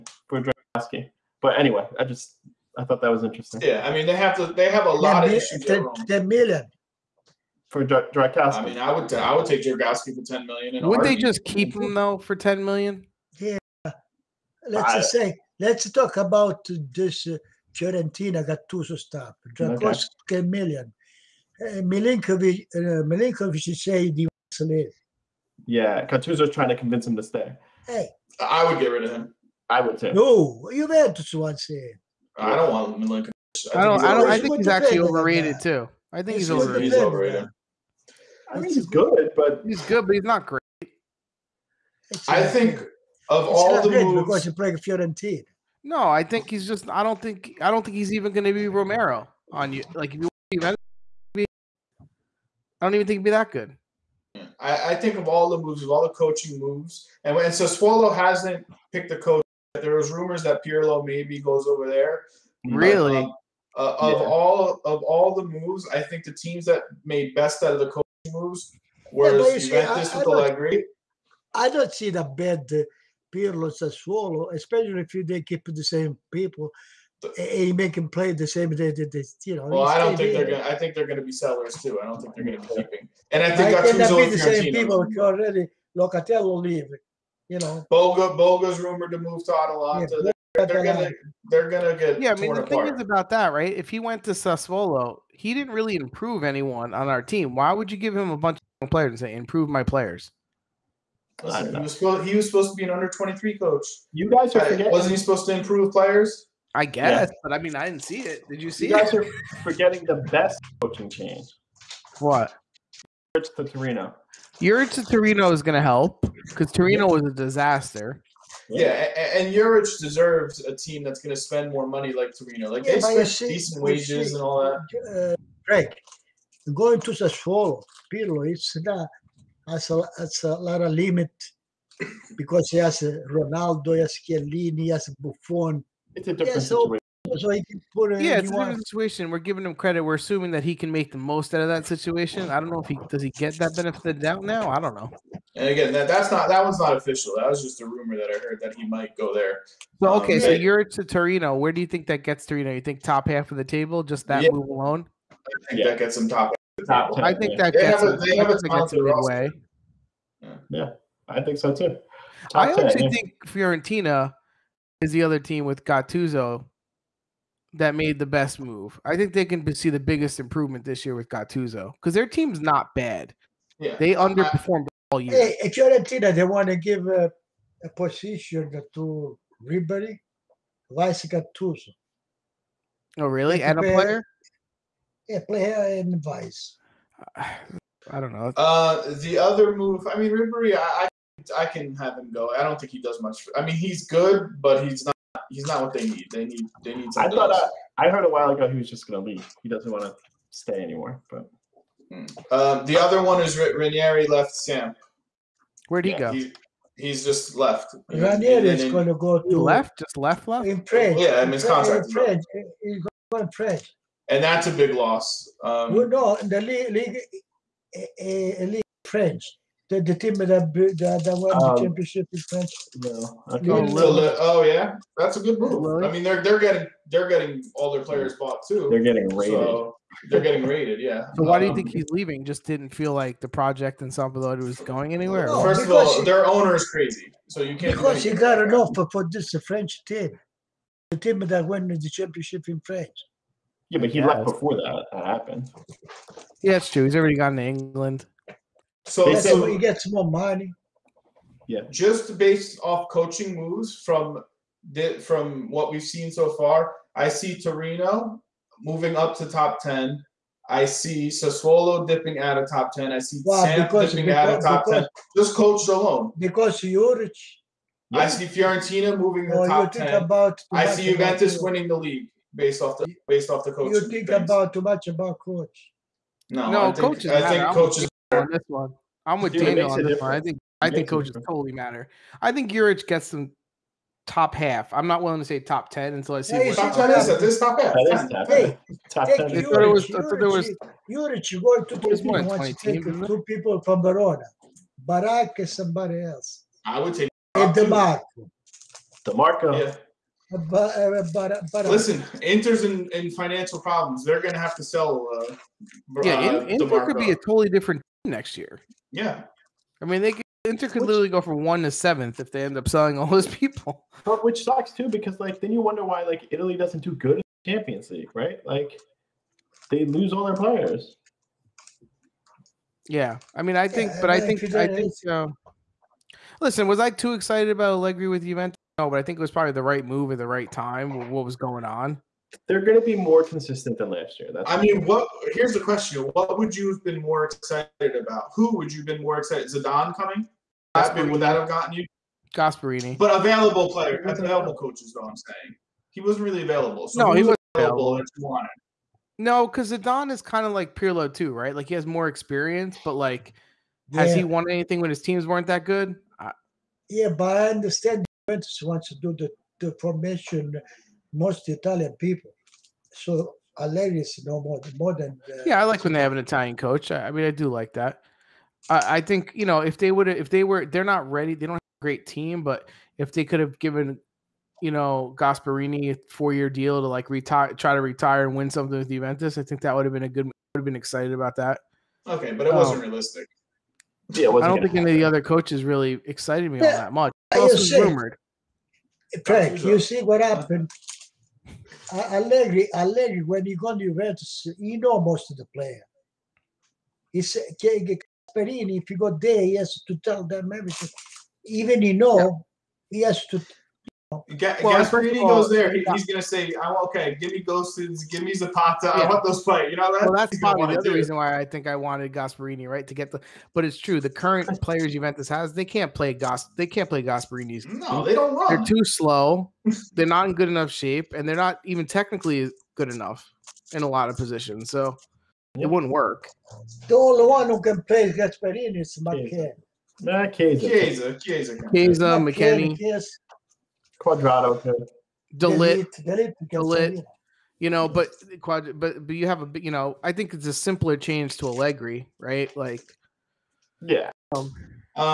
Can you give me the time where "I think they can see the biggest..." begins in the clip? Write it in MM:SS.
02:49.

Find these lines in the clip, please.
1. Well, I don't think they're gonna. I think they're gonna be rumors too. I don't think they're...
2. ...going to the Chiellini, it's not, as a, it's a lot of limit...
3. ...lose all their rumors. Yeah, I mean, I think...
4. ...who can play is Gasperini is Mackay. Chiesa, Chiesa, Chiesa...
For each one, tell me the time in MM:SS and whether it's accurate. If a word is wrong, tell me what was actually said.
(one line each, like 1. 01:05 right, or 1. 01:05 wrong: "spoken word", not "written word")
1. 01:19 wrong: "sellers", not "rumors"
2. 02:06 wrong: "Pirlo", not "Chiellini"
3. 05:20 wrong: "players", not "rumors"
4. 07:07 right.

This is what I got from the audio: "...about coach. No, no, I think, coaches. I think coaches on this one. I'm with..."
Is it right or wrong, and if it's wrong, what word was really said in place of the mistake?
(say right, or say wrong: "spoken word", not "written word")
right.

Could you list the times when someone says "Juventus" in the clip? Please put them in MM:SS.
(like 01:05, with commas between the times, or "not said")
00:30, 01:09, 04:31, 05:28, 05:58, 06:19, 06:34, 06:55.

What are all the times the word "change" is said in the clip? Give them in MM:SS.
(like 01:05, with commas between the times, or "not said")
01:51, 07:21.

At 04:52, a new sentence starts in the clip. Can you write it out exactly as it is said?
take two people from Verona, Barak and somebody else.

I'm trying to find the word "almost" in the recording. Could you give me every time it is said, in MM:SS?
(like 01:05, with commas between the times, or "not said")
not said.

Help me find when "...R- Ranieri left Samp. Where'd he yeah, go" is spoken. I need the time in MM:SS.
03:23.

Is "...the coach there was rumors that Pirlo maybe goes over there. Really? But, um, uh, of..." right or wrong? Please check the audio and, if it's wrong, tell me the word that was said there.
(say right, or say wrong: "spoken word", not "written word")
right.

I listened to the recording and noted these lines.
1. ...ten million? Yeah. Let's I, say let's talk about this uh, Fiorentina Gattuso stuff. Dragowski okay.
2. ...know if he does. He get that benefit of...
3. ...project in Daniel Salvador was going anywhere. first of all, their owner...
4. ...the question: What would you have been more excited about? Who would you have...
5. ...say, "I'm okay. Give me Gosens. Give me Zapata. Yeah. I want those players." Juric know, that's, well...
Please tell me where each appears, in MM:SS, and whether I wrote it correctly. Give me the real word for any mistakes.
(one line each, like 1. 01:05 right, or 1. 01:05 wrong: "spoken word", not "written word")
1. 00:12 right
2. 02:22 right
3. 03:53 wrong: "San", not "Daniel"
4. 05:35 right
5. 06:46 wrong: "You", not "Juric".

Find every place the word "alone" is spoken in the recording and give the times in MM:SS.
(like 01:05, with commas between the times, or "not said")
02:34, 04:25.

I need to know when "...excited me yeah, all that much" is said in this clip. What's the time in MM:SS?
06:26.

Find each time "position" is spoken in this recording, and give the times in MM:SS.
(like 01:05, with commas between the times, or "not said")
02:57, 07:04.